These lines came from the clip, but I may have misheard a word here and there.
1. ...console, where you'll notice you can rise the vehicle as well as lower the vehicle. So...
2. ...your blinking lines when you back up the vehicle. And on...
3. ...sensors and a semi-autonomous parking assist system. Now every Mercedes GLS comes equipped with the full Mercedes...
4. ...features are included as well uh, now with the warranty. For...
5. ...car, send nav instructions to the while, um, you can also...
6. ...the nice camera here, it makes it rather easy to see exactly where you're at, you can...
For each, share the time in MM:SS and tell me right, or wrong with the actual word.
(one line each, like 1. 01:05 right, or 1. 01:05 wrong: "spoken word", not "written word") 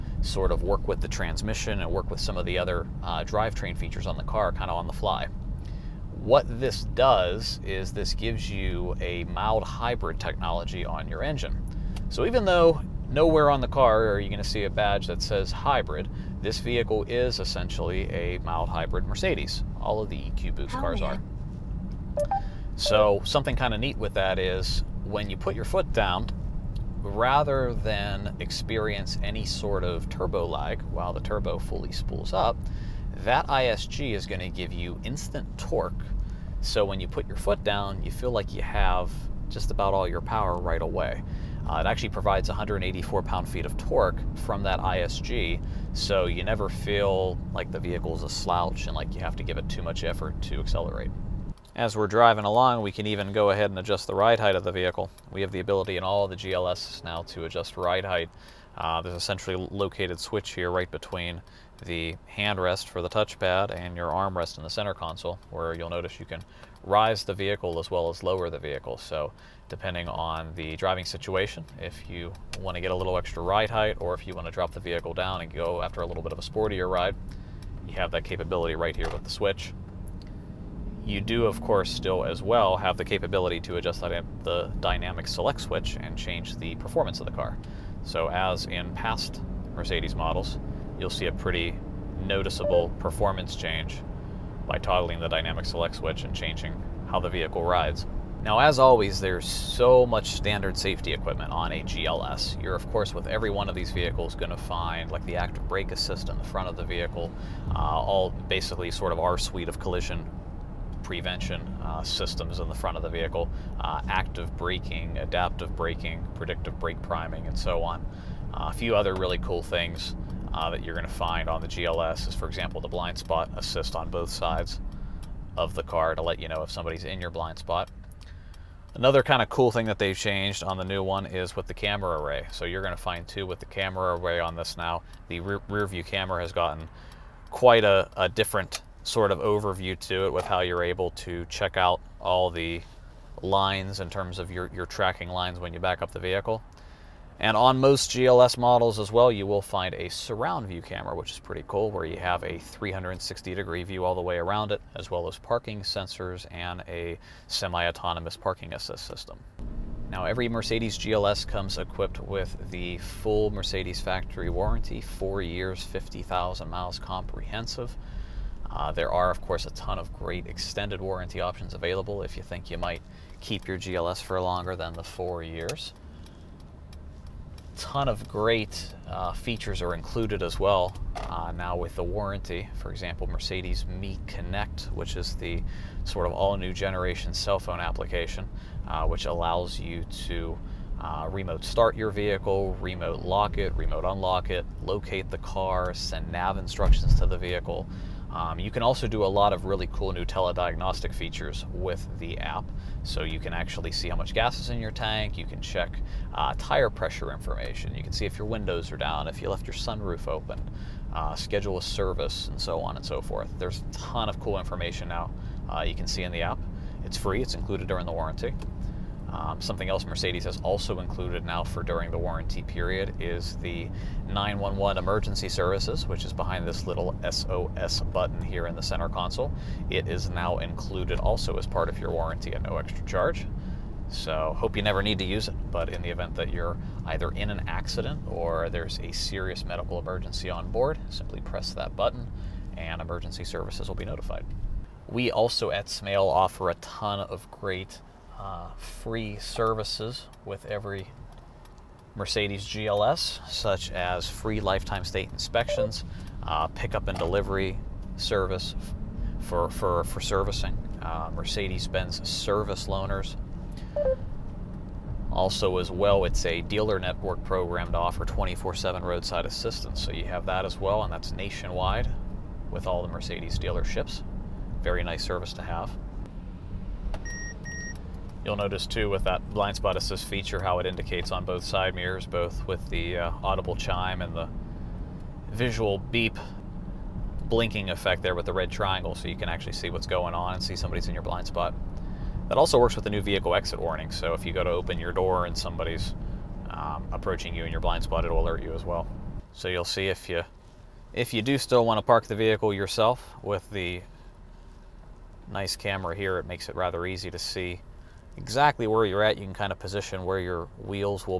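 1. 01:04 right
2. 02:24 wrong: "tracking", not "blinking"
3. 02:35 right
4. 02:59 right
5. 03:15 wrong: "vehicle", not "while"
6. 05:03 right.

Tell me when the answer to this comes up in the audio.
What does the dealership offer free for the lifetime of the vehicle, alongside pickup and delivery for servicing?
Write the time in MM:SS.
04:15.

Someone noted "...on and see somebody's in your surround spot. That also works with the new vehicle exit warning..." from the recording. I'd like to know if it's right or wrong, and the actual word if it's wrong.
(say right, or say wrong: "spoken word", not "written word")
wrong: "blind", not "surround".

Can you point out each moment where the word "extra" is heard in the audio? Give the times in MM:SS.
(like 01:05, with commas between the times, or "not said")
01:13, 03:52.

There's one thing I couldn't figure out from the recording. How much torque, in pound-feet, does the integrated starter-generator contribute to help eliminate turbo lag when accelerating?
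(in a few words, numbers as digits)
184.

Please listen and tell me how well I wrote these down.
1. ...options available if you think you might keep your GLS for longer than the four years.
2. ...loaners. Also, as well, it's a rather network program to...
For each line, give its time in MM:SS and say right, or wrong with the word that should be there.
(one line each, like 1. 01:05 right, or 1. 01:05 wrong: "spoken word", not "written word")
1. 02:51 right
2. 04:22 wrong: "dealer", not "rather".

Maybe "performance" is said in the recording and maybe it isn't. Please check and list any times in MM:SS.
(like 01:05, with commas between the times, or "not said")
01:26, 01:32.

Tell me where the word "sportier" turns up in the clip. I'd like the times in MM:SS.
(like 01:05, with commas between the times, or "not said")
01:16.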